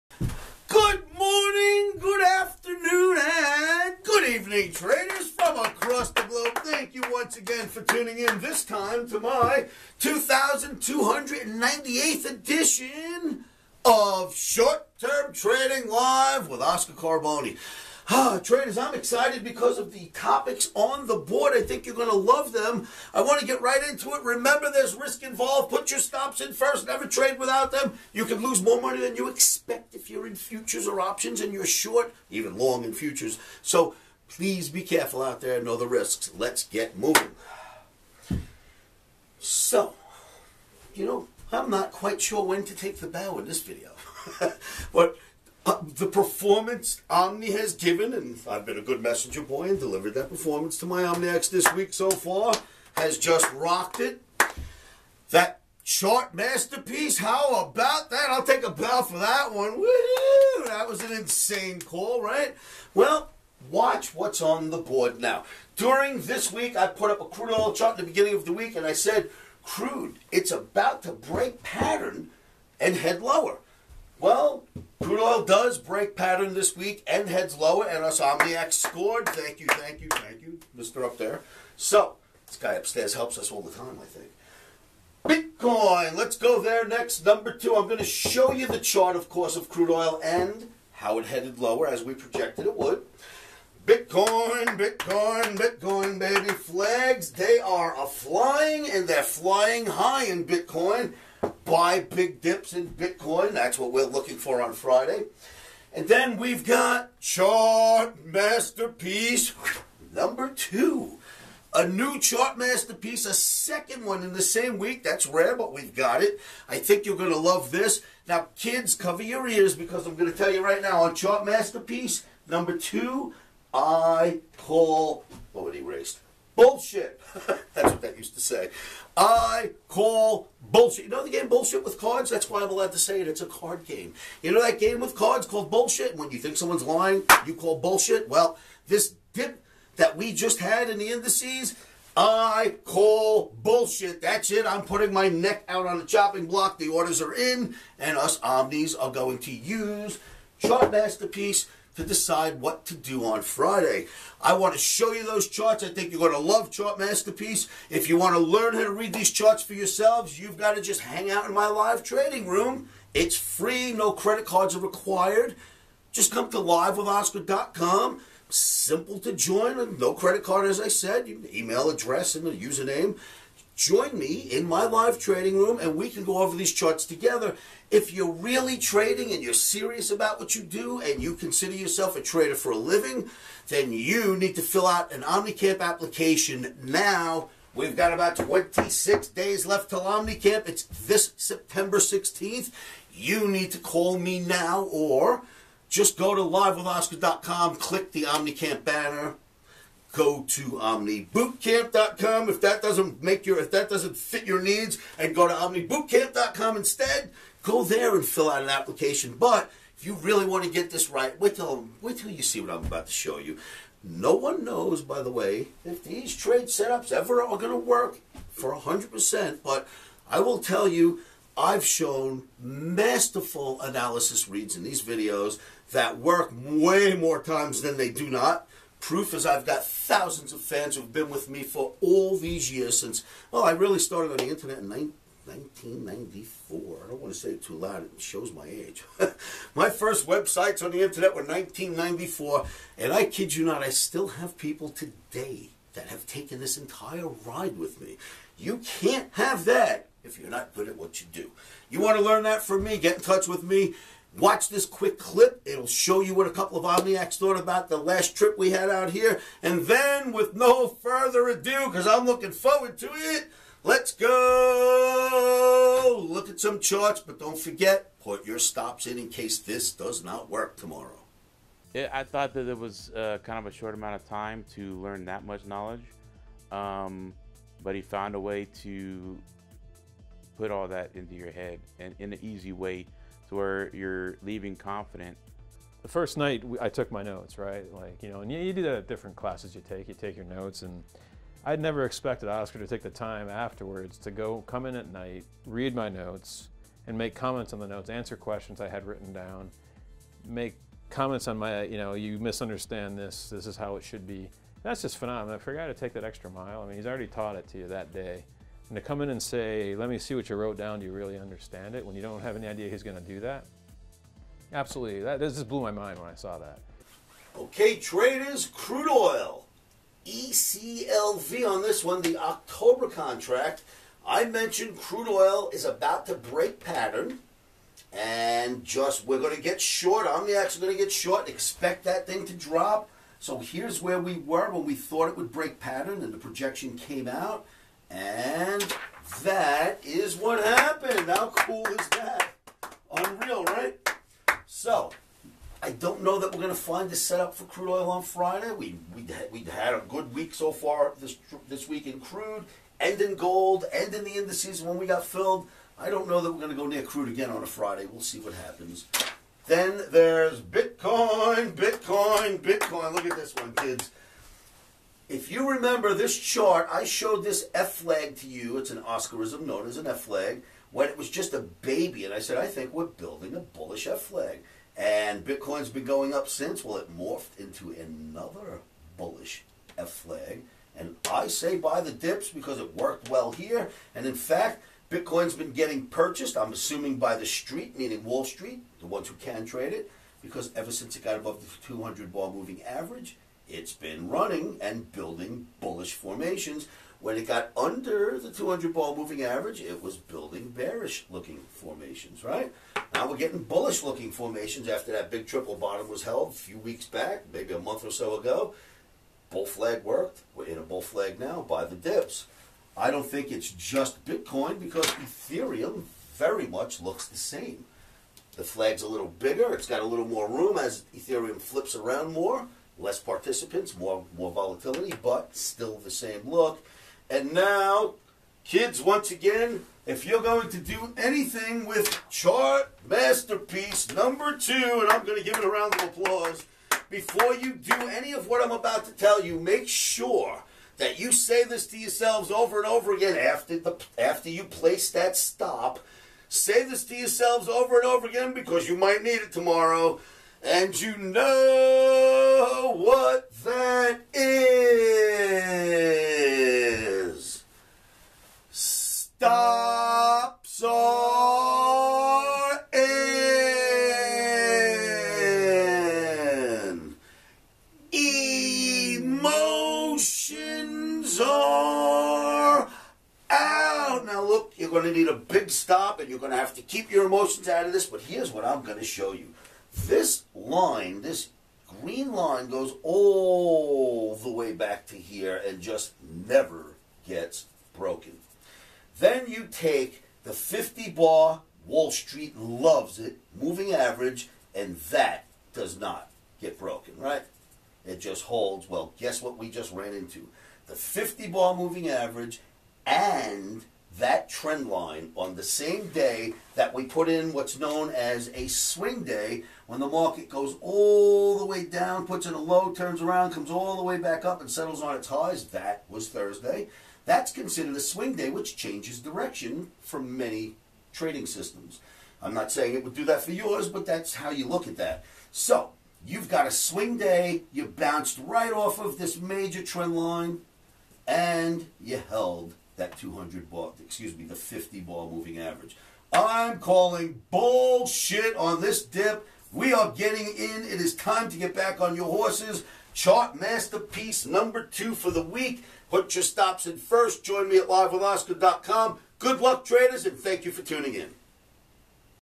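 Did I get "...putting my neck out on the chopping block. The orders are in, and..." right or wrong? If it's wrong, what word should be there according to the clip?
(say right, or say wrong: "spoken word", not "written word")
right.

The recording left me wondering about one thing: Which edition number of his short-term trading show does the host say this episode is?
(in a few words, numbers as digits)
2298th.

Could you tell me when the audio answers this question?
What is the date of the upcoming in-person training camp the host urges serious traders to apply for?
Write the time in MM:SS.
03:11.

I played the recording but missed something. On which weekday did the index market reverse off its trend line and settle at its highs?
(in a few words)
Thursday.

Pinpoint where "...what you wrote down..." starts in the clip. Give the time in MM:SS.
05:10.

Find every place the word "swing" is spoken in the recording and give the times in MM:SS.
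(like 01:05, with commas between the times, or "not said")
08:28, 08:38, 08:46.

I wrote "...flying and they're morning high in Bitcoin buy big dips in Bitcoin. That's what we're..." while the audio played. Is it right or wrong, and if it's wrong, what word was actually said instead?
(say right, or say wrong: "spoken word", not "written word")
wrong: "flying", not "morning".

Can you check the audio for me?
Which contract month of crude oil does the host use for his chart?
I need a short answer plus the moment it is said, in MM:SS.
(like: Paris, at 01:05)
October, at 05:22.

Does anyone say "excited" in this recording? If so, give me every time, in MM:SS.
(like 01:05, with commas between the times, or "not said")
00:18.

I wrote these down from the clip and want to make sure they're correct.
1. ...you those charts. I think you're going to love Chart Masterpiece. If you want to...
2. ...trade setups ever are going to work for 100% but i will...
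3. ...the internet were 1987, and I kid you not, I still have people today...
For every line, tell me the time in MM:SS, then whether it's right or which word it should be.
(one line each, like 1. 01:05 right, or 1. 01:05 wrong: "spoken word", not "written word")
1. 02:35 right
2. 03:36 right
3. 04:00 wrong: "1994", not "1987".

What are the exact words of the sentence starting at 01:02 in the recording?
Well, watch what's on the board now.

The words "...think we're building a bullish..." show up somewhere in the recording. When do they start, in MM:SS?
06:12.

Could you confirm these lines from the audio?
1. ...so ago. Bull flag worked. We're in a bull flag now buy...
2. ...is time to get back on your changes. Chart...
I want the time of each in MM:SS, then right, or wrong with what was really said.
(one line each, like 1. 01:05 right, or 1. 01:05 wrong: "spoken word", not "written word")
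1. 06:48 right
2. 09:01 wrong: "horses", not "changes".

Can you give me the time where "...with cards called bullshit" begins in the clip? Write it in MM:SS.
02:14.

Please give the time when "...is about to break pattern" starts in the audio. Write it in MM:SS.
05:25.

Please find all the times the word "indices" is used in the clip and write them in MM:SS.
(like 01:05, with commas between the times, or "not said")
02:21, 05:54.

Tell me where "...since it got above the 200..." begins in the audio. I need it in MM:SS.
06:30.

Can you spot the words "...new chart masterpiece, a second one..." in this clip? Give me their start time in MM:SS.
01:51.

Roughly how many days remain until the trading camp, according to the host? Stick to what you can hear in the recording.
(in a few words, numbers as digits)
26.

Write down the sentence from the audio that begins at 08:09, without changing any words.
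Then you take the 50 bar, Wall Street loves it, moving average, and that does not get broken, right?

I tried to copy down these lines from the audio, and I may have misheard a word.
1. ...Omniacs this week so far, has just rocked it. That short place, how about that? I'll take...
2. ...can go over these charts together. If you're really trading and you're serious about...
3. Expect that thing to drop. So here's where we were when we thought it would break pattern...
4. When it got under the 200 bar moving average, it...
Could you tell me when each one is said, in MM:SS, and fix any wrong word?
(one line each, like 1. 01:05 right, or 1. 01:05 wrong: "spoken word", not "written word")
1. 00:51 wrong: "masterpiece", not "place"
2. 02:56 right
3. 05:31 right
4. 06:37 right.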